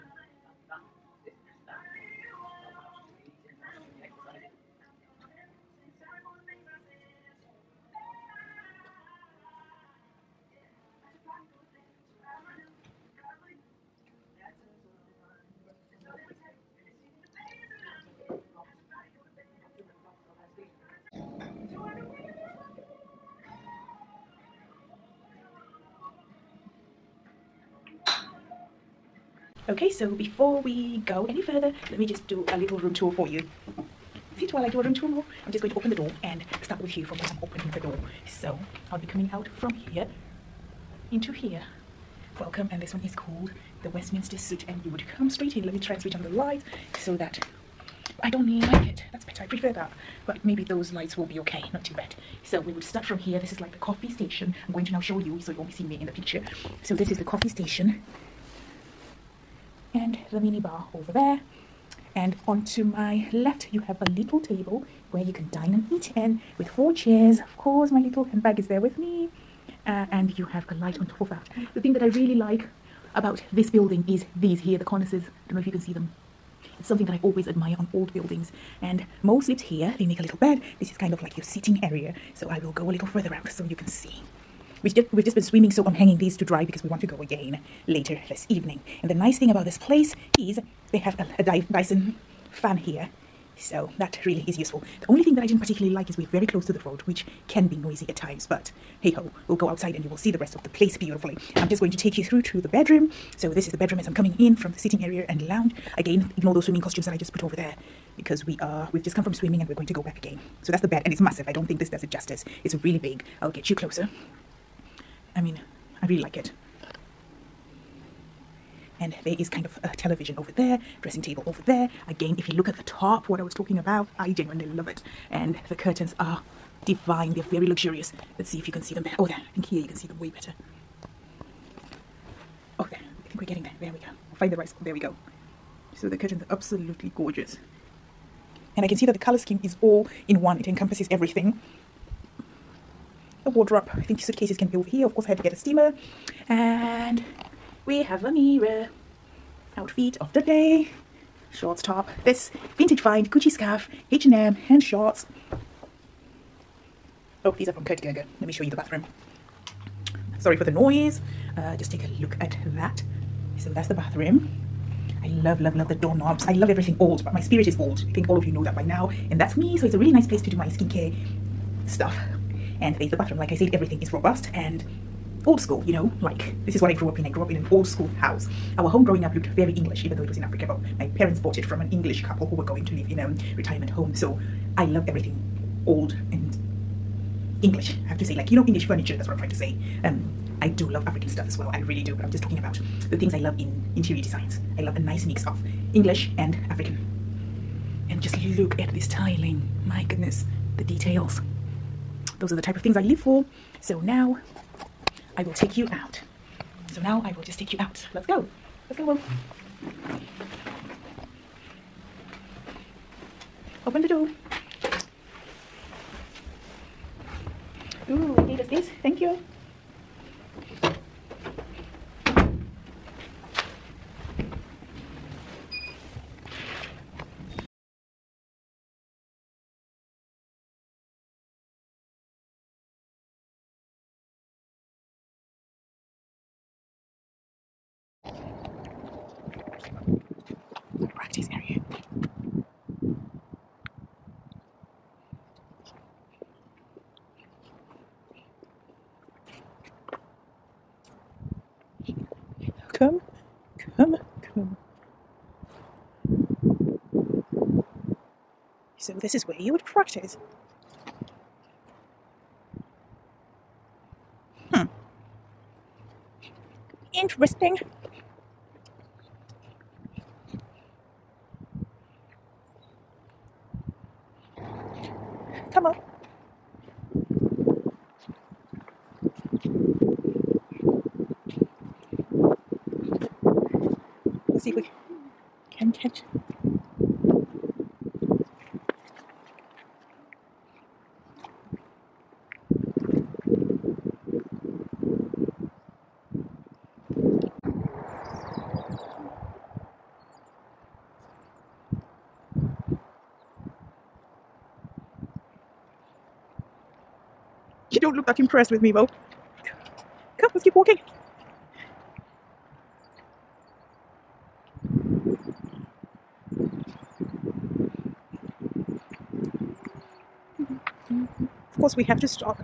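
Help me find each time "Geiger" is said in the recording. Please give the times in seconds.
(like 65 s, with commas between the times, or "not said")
158 s.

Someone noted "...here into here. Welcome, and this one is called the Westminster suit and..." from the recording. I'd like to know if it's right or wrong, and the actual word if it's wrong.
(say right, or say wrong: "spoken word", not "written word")
right.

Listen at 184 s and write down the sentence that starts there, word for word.
So I love everything old and English.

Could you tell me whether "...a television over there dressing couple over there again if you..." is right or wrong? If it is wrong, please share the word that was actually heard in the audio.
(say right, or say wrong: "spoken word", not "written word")
wrong: "table", not "couple".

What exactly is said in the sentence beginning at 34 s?
Sit while I do a room tour more.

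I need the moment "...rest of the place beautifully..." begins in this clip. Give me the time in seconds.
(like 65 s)
100 s.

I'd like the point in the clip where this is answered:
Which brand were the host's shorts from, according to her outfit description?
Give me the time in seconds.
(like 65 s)
154 s.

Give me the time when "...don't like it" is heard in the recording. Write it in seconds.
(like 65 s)
48 s.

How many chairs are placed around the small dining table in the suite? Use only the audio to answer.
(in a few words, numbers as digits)
4.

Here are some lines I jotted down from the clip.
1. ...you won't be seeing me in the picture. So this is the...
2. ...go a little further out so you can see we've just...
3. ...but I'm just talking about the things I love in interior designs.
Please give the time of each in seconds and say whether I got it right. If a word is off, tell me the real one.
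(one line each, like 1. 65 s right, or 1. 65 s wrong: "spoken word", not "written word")
1. 55 s right
2. 82 s right
3. 192 s right.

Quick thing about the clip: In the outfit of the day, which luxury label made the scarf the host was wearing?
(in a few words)
Gucci.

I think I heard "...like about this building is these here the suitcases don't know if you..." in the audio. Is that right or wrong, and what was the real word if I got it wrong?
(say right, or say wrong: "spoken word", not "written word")
wrong: "cornices", not "suitcases".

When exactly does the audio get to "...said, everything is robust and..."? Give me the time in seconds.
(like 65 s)
173 s.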